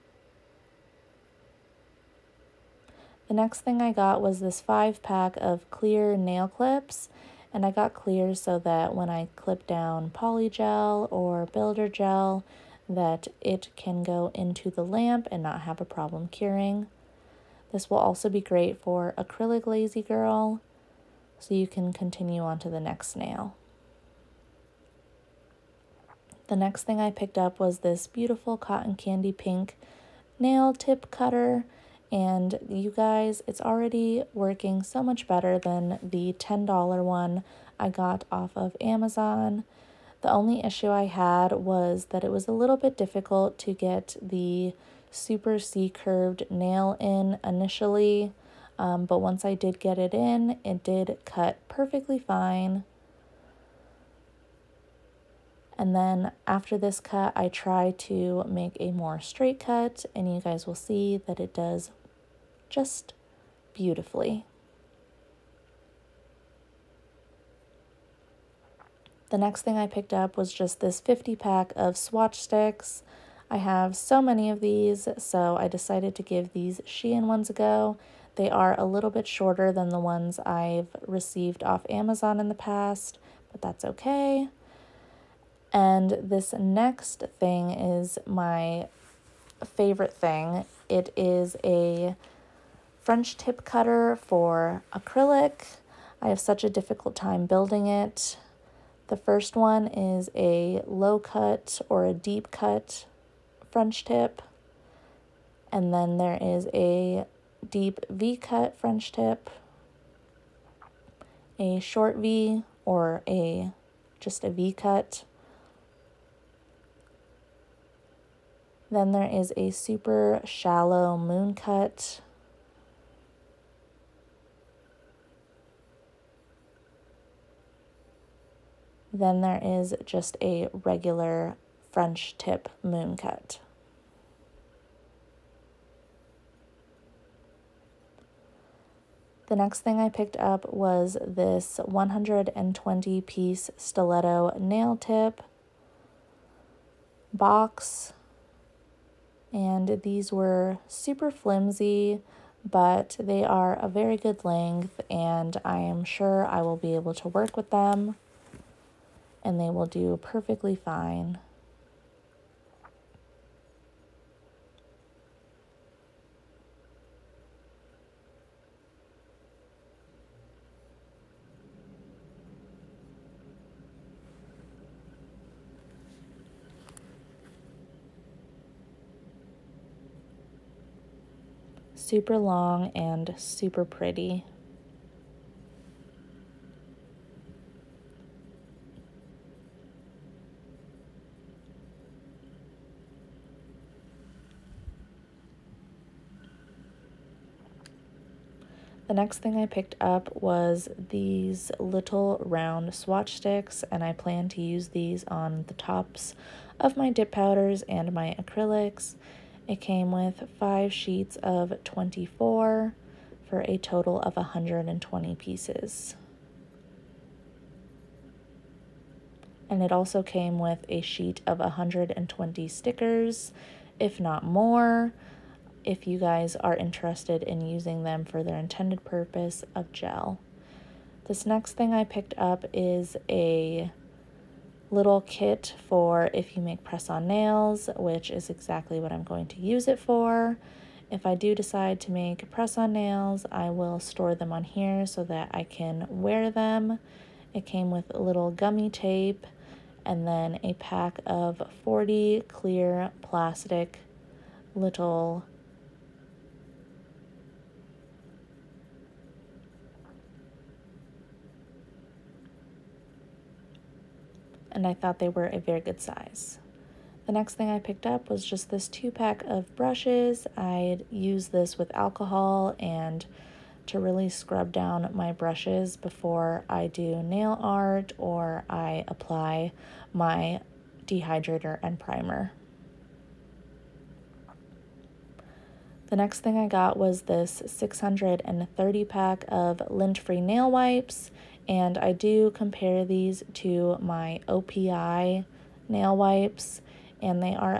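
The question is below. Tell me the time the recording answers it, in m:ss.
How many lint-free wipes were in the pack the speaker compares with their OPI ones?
4:47.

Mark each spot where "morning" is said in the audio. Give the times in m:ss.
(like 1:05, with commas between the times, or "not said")
not said.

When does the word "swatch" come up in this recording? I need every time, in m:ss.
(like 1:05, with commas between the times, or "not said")
1:11, 3:22.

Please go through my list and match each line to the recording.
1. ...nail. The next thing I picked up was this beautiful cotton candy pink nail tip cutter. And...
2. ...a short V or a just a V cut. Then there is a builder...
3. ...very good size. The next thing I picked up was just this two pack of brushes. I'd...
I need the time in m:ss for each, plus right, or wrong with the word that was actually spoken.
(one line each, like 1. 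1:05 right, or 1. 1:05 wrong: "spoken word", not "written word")
1. 0:23 right
2. 1:51 wrong: "super", not "builder"
3. 4:25 right.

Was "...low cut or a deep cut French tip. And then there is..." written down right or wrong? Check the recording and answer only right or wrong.
right.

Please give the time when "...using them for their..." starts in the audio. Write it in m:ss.
3:47.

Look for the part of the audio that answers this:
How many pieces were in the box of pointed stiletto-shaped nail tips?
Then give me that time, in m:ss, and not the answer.
2:21.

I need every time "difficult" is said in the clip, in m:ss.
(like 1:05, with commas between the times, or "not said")
0:42, 1:36.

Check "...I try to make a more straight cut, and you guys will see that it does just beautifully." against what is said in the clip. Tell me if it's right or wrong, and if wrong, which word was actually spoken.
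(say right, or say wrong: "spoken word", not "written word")
right.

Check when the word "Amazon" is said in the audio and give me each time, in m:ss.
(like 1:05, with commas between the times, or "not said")
0:38, 1:21.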